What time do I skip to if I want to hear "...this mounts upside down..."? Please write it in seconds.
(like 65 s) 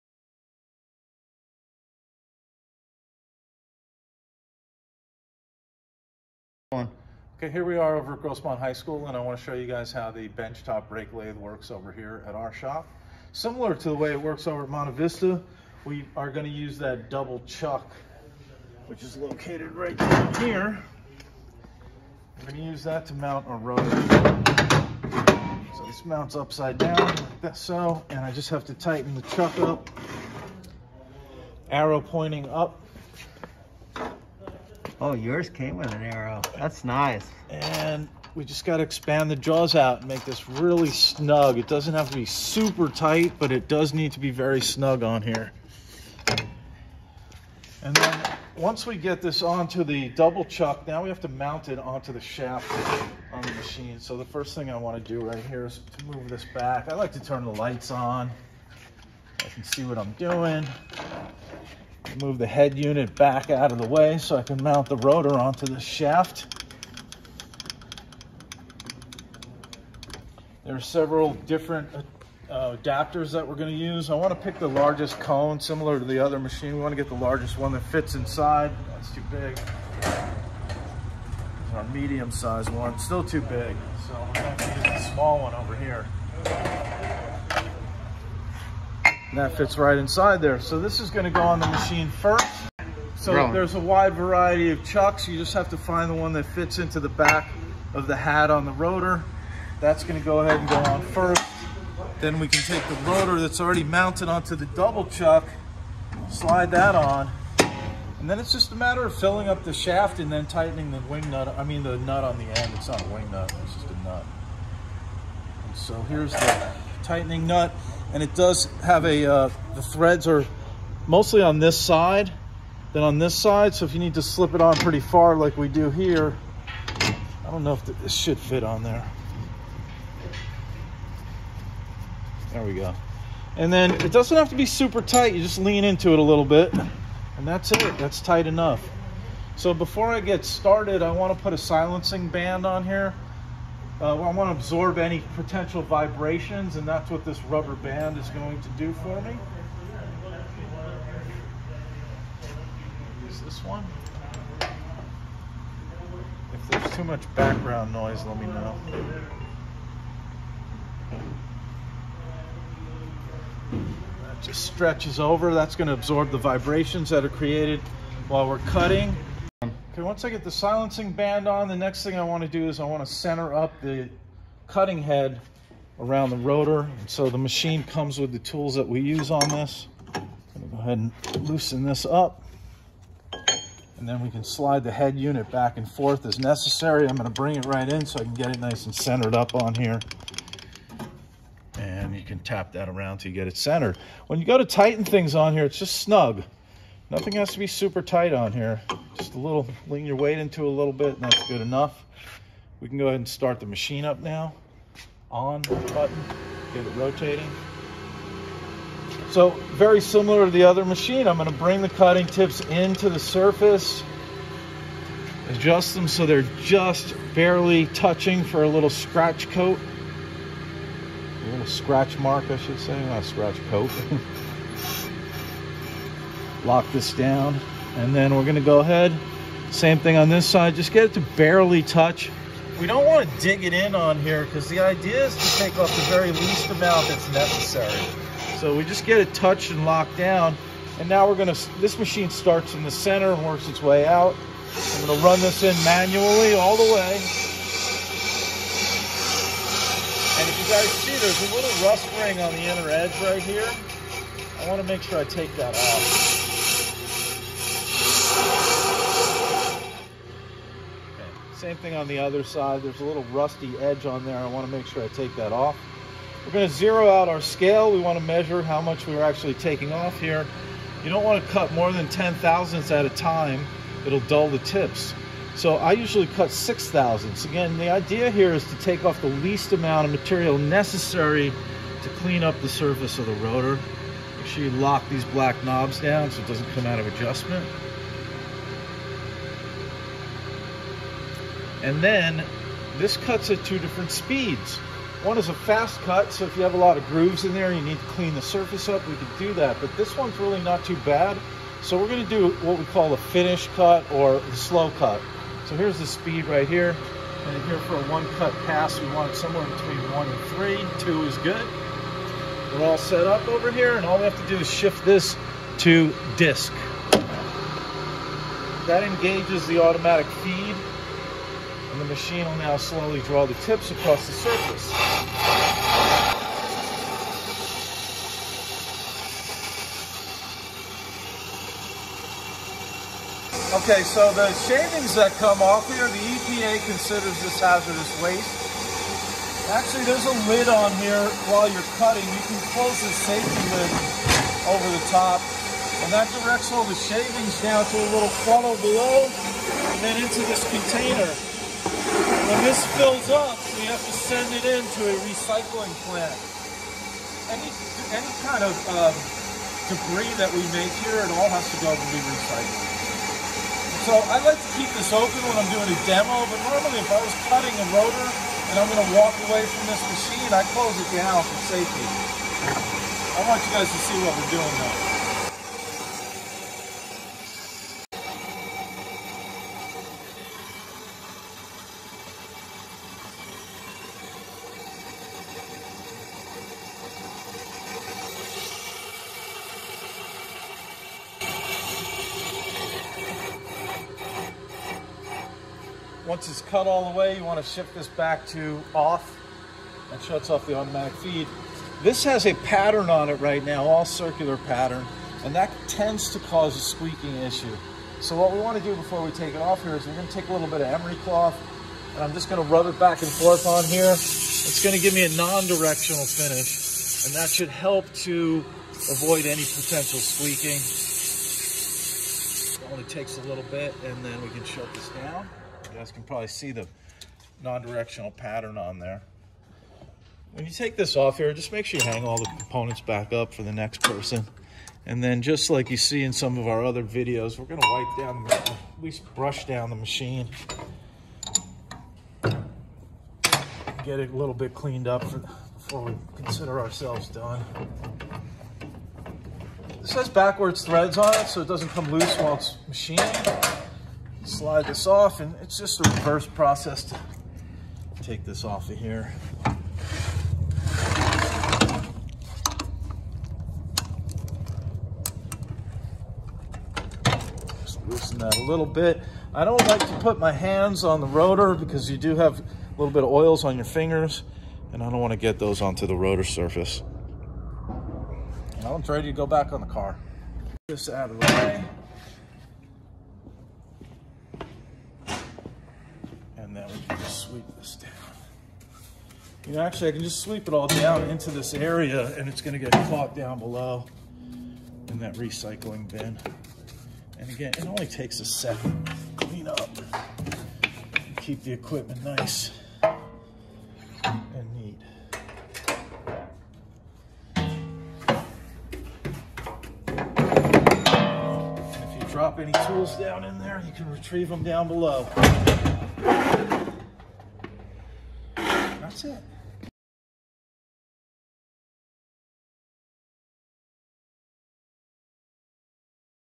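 25 s.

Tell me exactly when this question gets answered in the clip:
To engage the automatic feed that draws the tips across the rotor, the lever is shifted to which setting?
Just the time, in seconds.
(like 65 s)
316 s.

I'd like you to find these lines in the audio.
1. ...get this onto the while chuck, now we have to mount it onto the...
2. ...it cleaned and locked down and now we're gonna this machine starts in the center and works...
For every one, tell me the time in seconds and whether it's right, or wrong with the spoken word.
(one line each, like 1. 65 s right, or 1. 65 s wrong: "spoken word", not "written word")
1. 48 s wrong: "double", not "while"
2. 239 s wrong: "touched", not "cleaned".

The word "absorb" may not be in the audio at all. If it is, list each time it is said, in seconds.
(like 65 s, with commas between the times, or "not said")
144 s, 165 s.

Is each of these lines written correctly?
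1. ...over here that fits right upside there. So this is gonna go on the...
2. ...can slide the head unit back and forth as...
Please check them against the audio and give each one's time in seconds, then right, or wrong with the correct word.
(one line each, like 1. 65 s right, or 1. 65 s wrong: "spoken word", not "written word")
1. 85 s wrong: "inside", not "upside"
2. 184 s right.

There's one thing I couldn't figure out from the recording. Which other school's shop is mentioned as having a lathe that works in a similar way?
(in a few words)
Monte Vista.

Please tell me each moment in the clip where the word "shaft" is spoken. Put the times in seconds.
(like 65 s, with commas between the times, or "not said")
52 s, 65 s, 109 s.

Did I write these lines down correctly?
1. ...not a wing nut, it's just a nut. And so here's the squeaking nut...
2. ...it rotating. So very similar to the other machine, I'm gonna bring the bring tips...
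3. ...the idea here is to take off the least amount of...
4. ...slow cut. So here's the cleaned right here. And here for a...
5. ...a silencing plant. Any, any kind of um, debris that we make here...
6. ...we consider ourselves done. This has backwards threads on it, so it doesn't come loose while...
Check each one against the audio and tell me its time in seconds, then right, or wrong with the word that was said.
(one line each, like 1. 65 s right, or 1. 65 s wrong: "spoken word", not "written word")
1. 112 s wrong: "tightening", not "squeaking"
2. 206 s wrong: "cutting", not "bring"
3. 277 s right
4. 304 s wrong: "speed", not "cleaned"
5. 355 s wrong: "recycling", not "silencing"
6. 446 s right.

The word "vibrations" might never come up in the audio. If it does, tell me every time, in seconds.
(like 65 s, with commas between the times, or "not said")
145 s, 166 s.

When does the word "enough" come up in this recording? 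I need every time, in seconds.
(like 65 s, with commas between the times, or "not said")
138 s, 201 s.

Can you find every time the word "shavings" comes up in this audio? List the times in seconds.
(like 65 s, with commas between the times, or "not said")
334 s, 346 s.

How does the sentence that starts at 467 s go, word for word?
Just loosen that a little bit.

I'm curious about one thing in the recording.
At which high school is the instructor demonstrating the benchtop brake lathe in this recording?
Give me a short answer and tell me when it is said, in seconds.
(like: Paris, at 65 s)
Grossmont High School, at 8 s.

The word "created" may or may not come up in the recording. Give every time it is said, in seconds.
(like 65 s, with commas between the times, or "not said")
167 s.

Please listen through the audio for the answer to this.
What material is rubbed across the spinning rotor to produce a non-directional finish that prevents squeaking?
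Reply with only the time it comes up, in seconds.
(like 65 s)
410 s.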